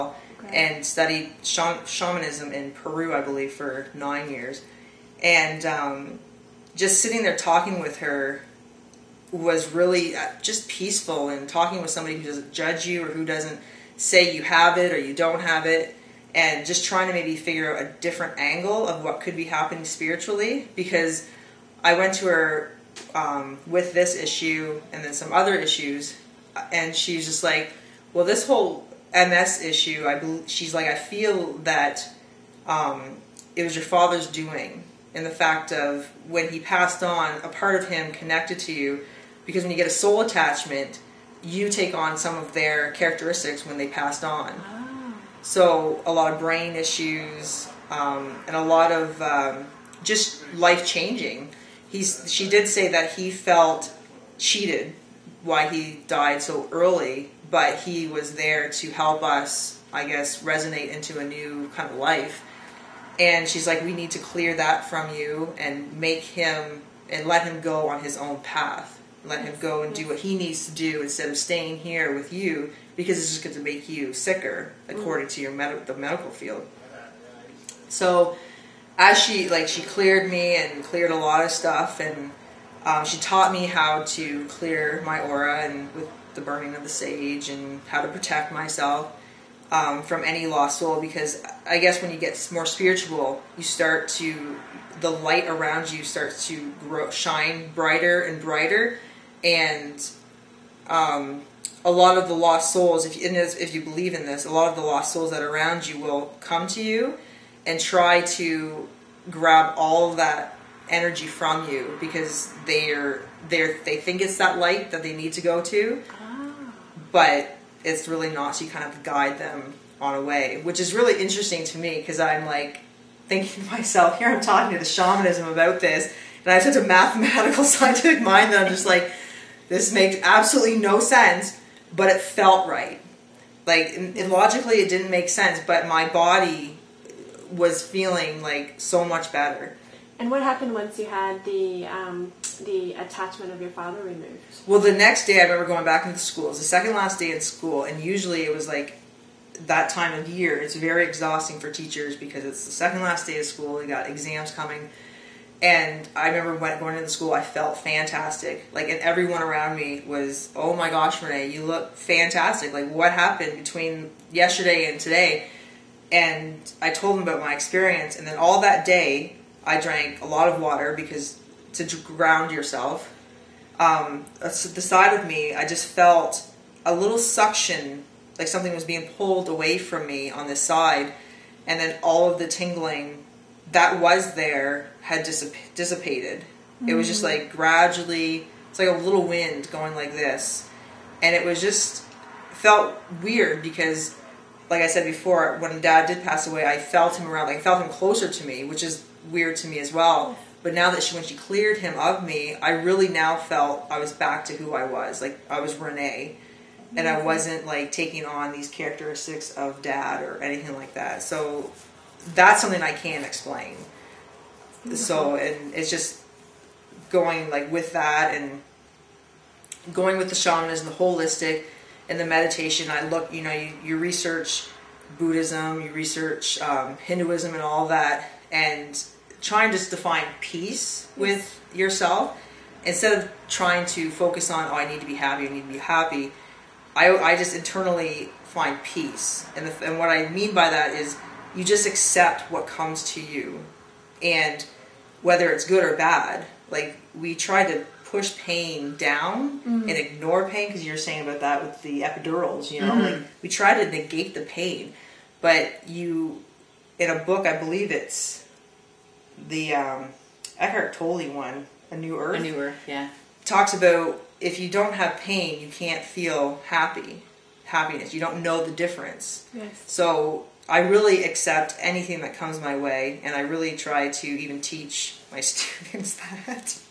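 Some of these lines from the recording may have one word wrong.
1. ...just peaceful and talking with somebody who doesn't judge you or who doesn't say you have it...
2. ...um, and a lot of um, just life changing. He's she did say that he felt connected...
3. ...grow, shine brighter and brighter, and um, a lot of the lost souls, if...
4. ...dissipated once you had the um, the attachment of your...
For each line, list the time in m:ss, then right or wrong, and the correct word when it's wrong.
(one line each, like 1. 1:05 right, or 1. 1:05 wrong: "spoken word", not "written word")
1. 0:10 right
2. 0:47 wrong: "cheated", not "connected"
3. 1:36 right
4. 2:20 wrong: "happened", not "dissipated".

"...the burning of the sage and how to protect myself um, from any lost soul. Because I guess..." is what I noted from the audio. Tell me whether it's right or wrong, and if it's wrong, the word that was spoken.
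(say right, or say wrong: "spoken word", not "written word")
right.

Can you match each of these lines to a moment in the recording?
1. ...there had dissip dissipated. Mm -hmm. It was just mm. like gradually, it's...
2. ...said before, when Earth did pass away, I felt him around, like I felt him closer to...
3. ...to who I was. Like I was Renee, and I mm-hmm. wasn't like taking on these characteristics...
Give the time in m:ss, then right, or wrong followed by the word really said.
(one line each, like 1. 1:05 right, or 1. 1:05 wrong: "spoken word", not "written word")
1. 3:04 right
2. 3:14 wrong: "Dad", not "Earth"
3. 3:24 right.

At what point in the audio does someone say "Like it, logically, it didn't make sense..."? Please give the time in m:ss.
2:13.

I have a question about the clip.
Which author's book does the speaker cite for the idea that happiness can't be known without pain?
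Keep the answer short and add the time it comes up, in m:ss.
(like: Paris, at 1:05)
Eckhart Tolle, at 4:20.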